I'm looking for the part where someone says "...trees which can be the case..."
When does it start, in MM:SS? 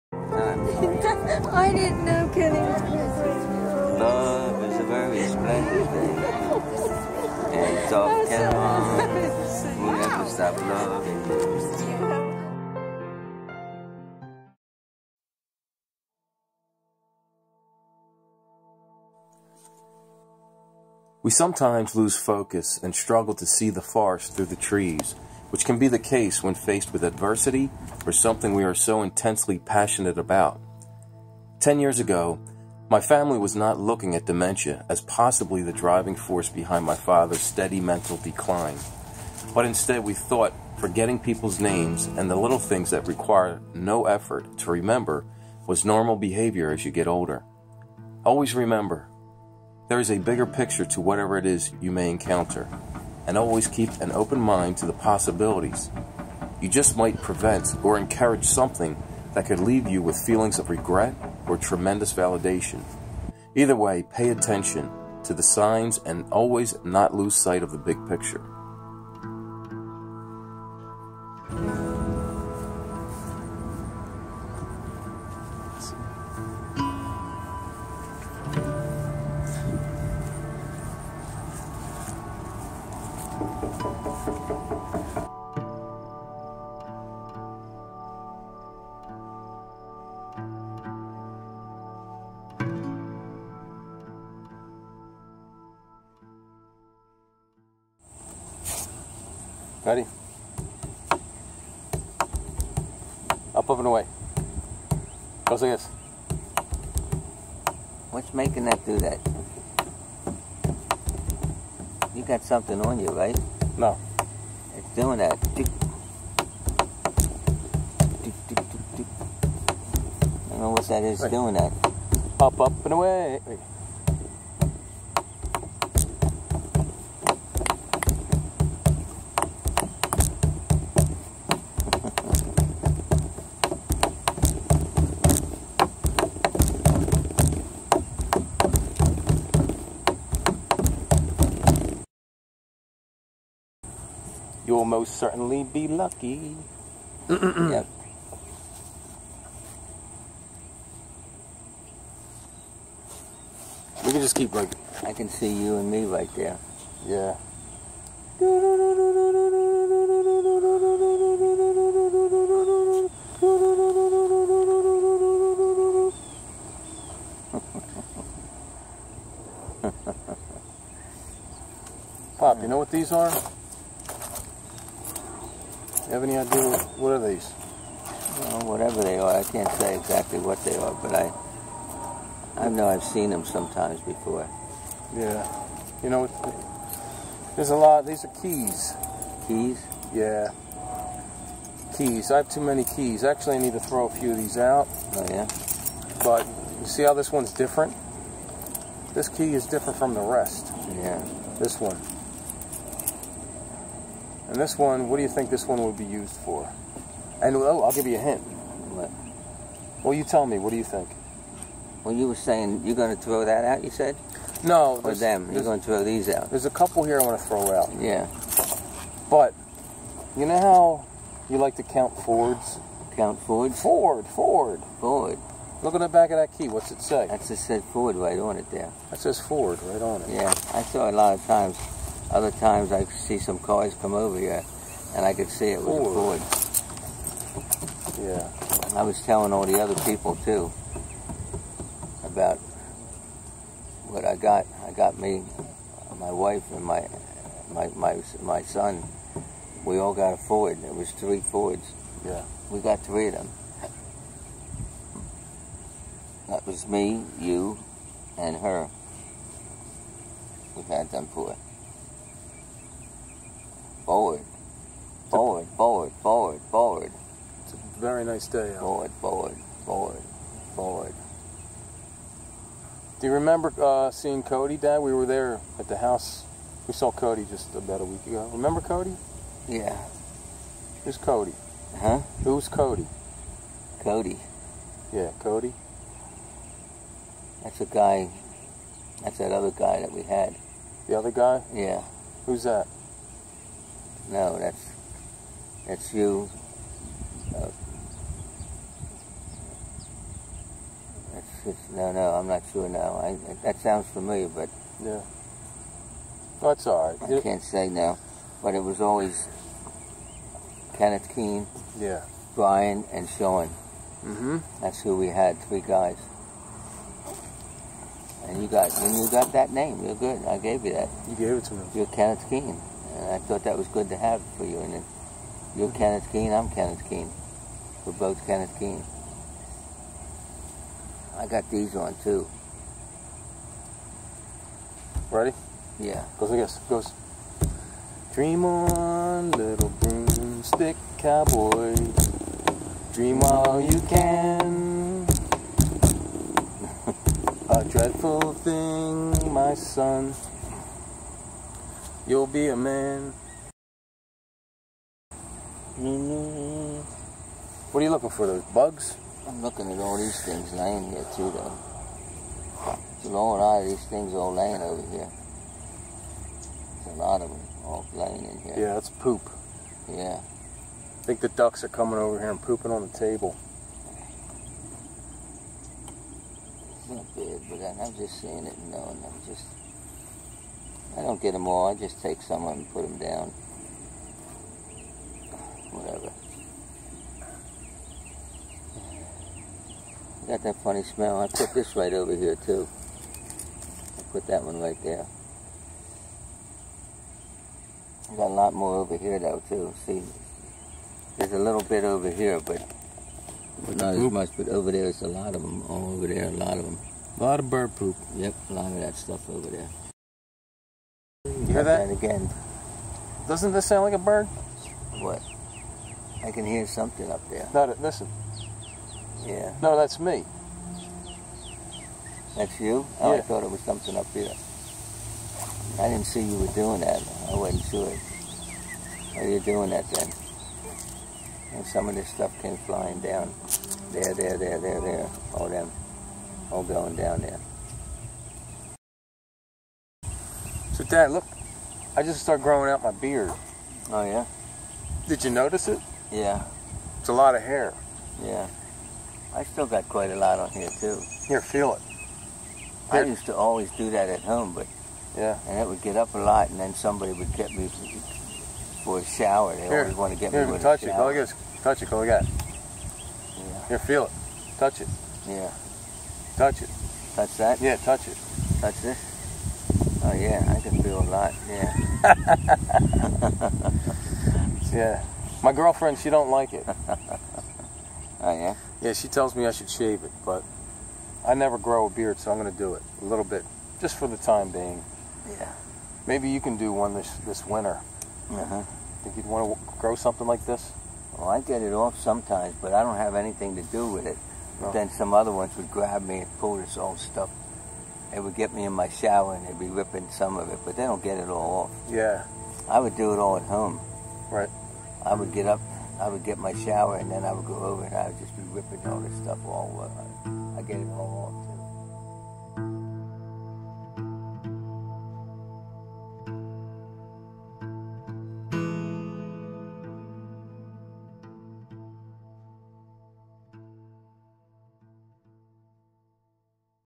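00:24.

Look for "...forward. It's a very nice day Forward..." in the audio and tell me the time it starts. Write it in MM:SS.
04:26.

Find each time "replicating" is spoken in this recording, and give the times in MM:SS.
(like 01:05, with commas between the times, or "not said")
not said.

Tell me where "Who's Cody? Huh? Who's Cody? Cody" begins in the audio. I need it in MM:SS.
04:41.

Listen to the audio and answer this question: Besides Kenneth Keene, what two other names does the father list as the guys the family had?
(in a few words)
Brian and Sean.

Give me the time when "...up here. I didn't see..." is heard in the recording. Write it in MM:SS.
07:04.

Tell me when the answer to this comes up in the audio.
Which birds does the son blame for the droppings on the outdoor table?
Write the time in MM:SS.
06:11.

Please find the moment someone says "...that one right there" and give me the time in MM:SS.
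06:34.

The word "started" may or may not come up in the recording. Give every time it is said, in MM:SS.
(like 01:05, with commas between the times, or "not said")
07:22.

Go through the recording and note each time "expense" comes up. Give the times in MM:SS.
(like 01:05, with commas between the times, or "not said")
not said.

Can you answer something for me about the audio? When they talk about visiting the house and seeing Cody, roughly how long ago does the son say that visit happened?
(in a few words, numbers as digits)
About a week ago.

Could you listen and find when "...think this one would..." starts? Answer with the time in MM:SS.
03:25.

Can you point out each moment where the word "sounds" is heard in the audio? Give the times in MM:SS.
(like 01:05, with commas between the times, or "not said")
05:03, 06:53.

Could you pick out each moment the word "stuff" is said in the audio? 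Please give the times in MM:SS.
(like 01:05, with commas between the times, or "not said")
06:49, 07:12, 08:17, 08:29.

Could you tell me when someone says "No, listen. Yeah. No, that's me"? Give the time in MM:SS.
06:57.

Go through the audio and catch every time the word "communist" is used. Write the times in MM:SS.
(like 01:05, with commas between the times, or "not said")
not said.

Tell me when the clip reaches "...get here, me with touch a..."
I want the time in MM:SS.
07:40.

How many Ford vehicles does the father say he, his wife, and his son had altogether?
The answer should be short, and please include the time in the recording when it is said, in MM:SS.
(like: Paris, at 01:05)
3, at 04:11.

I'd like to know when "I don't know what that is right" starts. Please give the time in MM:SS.
01:55.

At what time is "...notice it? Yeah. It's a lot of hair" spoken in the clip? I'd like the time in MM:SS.
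07:25.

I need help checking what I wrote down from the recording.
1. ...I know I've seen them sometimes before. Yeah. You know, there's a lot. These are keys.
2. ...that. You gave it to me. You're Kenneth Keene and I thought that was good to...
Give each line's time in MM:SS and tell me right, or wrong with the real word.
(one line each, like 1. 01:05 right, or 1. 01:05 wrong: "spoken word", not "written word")
1. 03:02 right
2. 05:20 right.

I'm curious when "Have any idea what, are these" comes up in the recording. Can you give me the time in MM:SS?
02:56.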